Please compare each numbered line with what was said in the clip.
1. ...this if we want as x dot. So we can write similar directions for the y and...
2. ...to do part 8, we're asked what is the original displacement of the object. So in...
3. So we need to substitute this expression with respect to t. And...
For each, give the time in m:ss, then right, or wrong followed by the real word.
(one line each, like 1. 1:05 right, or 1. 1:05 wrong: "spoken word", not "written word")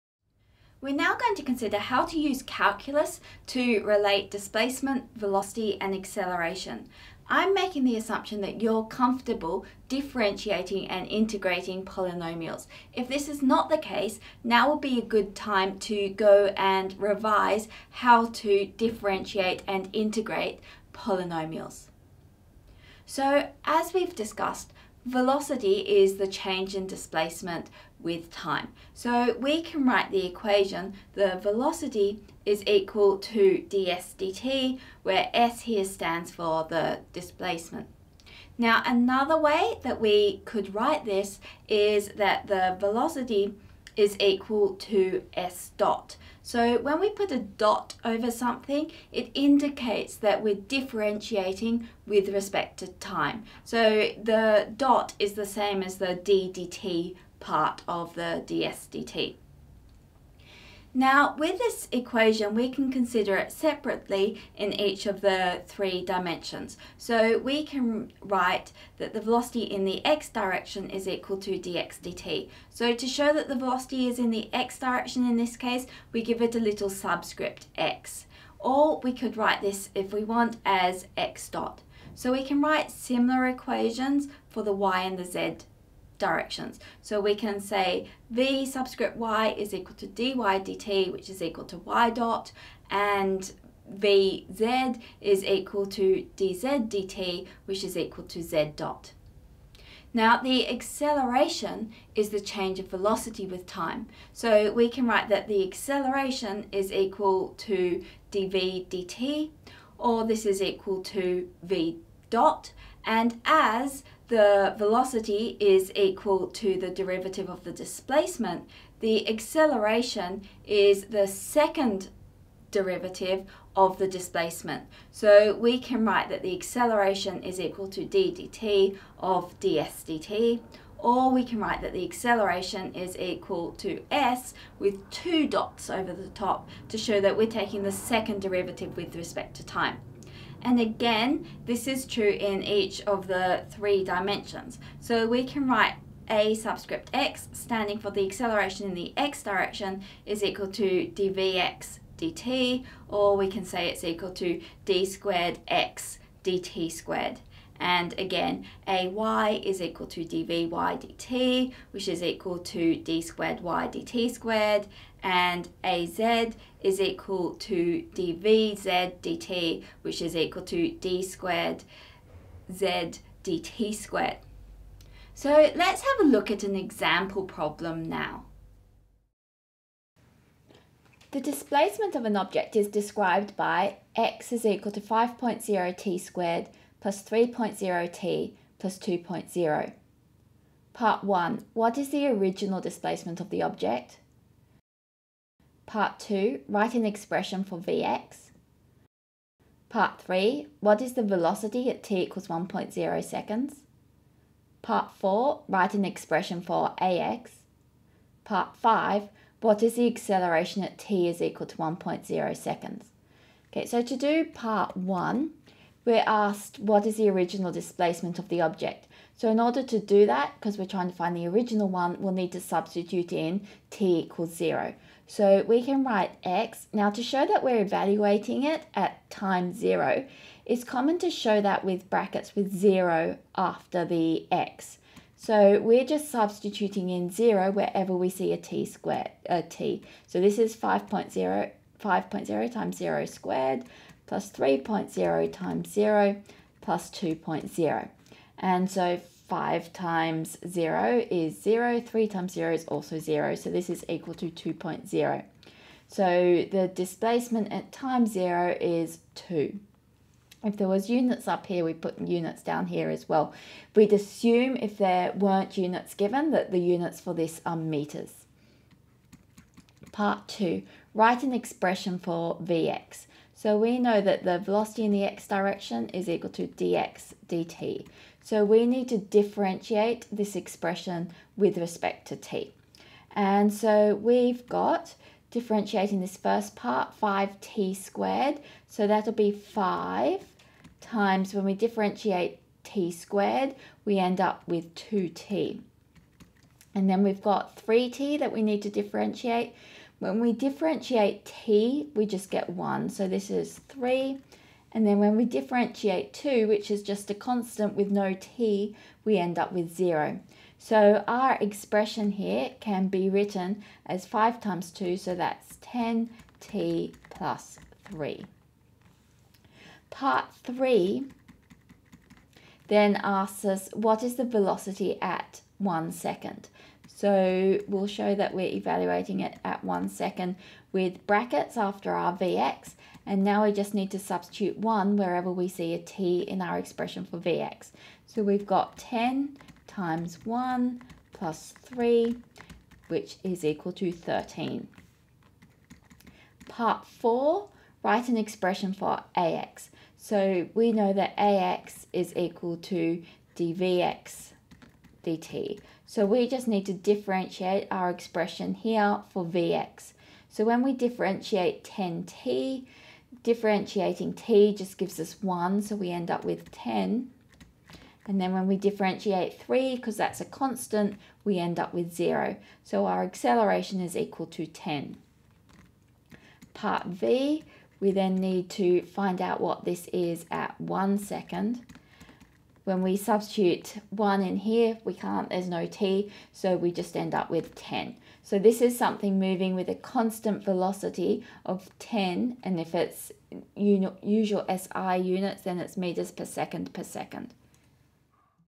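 1. 1:19 wrong: "equations", not "directions"
2. 3:34 wrong: "1", not "8"
3. 4:38 wrong: "differentiate", not "substitute".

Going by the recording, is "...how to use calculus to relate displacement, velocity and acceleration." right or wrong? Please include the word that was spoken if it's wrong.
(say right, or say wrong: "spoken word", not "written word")
right.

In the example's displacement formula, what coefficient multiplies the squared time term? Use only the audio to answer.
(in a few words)
5.0.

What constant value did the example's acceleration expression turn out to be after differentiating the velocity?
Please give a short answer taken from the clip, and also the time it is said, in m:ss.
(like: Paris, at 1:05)
10, at 6:13.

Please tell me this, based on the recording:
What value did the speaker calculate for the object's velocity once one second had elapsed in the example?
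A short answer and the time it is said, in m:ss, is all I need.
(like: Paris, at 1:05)
13, at 5:43.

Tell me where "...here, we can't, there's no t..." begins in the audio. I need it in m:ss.
6:24.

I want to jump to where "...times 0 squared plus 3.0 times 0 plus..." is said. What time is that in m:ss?
4:02.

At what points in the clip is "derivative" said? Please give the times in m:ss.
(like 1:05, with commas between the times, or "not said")
1:56, 2:02, 2:18.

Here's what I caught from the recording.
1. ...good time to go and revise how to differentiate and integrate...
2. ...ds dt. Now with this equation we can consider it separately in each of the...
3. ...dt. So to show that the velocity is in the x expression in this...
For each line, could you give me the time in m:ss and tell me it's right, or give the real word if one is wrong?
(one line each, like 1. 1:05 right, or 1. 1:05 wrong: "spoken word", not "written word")
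1. 0:15 right
2. 0:58 right
3. 1:12 wrong: "direction", not "expression".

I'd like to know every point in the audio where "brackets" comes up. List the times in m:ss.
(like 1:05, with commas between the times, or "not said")
3:52, 5:31.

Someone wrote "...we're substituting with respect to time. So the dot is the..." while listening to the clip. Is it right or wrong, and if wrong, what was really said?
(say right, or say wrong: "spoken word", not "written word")
wrong: "differentiating", not "substituting".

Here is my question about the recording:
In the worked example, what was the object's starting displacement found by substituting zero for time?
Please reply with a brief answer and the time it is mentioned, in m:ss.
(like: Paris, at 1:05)
2.0, at 4:13.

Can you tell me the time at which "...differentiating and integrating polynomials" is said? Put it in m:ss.
0:09.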